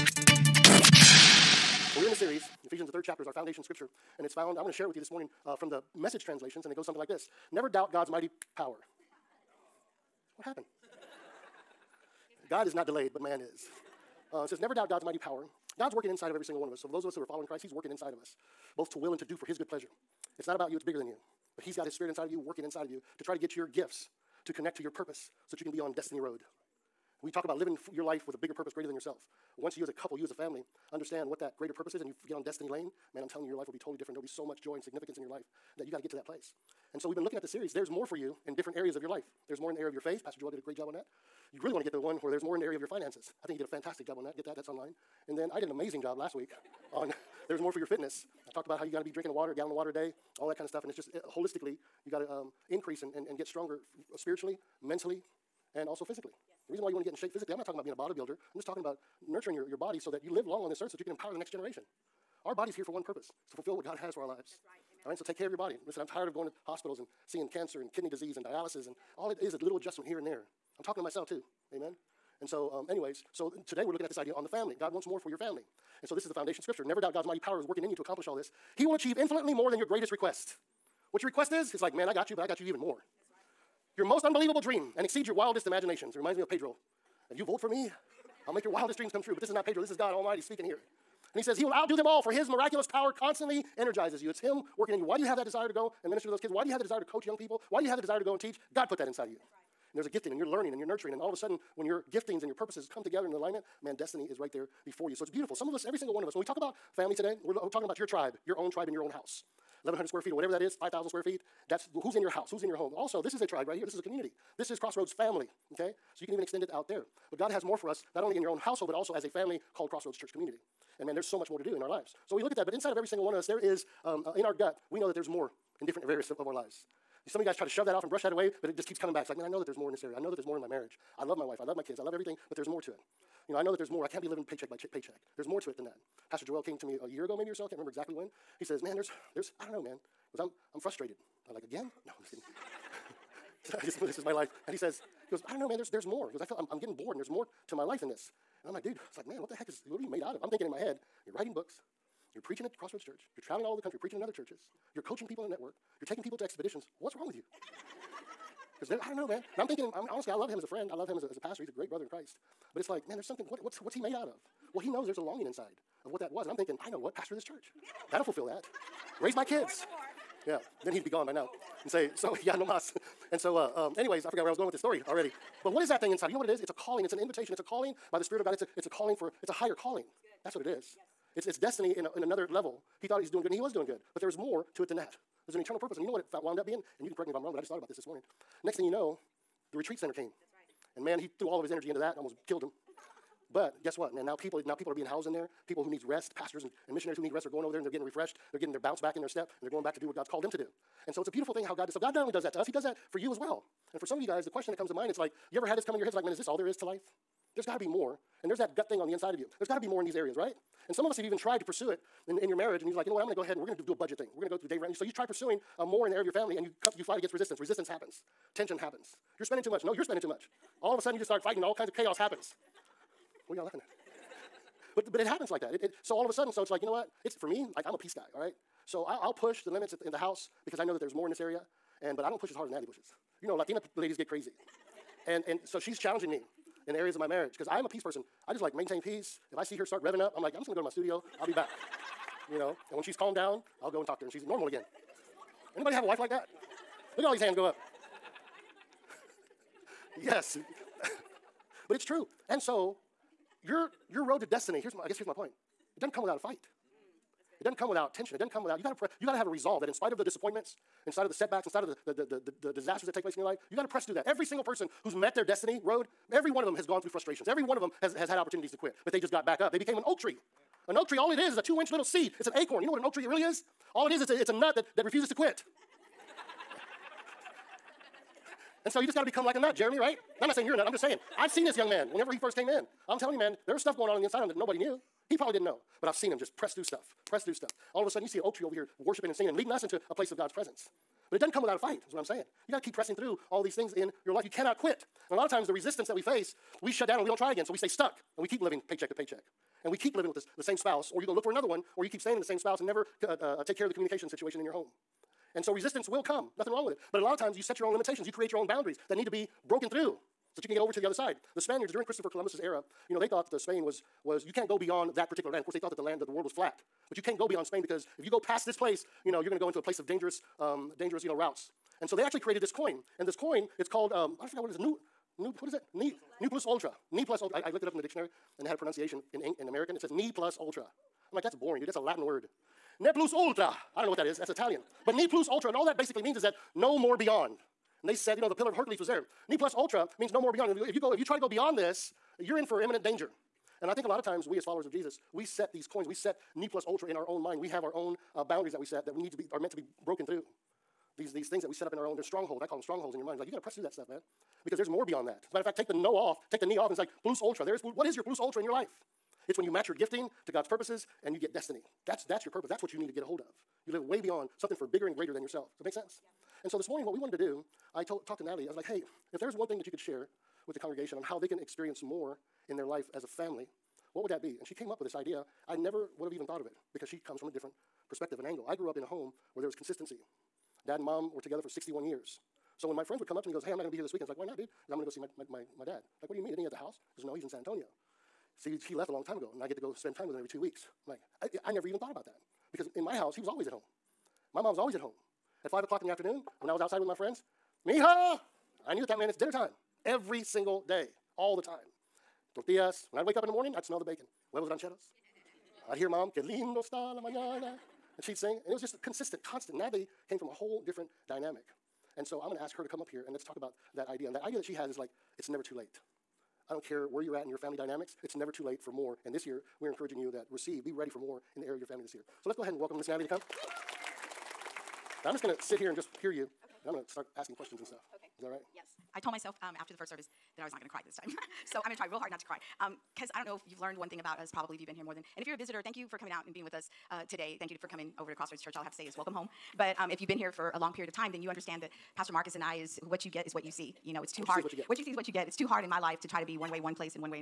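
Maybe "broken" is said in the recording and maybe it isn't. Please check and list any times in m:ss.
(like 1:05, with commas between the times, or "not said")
5:09, 5:50.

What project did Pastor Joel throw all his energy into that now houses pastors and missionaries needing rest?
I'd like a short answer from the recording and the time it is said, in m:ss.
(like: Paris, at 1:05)
The retreat center, at 3:09.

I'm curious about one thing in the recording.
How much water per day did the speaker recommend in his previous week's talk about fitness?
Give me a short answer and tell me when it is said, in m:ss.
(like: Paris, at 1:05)
A gallon, at 0:49.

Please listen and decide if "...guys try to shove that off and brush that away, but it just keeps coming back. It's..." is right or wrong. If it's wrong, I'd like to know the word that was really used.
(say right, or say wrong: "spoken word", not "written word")
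right.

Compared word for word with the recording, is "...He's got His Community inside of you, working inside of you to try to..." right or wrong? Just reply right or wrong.
wrong.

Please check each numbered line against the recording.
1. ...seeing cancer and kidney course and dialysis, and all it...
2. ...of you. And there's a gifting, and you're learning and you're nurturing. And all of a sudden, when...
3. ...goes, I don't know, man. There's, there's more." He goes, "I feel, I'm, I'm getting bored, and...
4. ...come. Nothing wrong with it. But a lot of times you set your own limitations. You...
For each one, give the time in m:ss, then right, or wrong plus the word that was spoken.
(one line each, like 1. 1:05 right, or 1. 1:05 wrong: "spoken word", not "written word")
1. 1:07 wrong: "disease", not "course"
2. 1:39 right
3. 2:25 right
4. 5:06 right.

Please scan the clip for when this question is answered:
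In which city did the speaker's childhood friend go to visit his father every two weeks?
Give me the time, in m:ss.
6:27.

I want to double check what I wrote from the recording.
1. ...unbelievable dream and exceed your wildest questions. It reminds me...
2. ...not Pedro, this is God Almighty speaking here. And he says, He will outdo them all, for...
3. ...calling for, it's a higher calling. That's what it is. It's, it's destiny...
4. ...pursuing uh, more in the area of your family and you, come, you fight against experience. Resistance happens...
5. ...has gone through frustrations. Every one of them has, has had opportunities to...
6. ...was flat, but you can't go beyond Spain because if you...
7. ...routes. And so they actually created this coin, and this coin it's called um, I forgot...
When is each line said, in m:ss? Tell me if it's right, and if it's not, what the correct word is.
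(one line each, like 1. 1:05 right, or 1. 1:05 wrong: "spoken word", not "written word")
1. 1:24 wrong: "imaginations", not "questions"
2. 1:29 right
3. 2:58 right
4. 3:35 wrong: "resistance", not "experience"
5. 4:26 right
6. 5:16 right
7. 5:21 right.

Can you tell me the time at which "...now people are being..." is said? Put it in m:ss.
3:14.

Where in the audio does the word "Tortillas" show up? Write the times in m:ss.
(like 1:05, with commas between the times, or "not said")
6:42.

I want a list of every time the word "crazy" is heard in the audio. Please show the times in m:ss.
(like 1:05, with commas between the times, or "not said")
3:54.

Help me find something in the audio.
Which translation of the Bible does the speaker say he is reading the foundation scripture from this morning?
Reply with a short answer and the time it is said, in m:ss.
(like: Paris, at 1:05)
The Message, at 0:05.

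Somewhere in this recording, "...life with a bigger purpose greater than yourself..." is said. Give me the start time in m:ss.
0:28.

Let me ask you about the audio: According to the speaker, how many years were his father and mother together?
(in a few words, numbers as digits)
61.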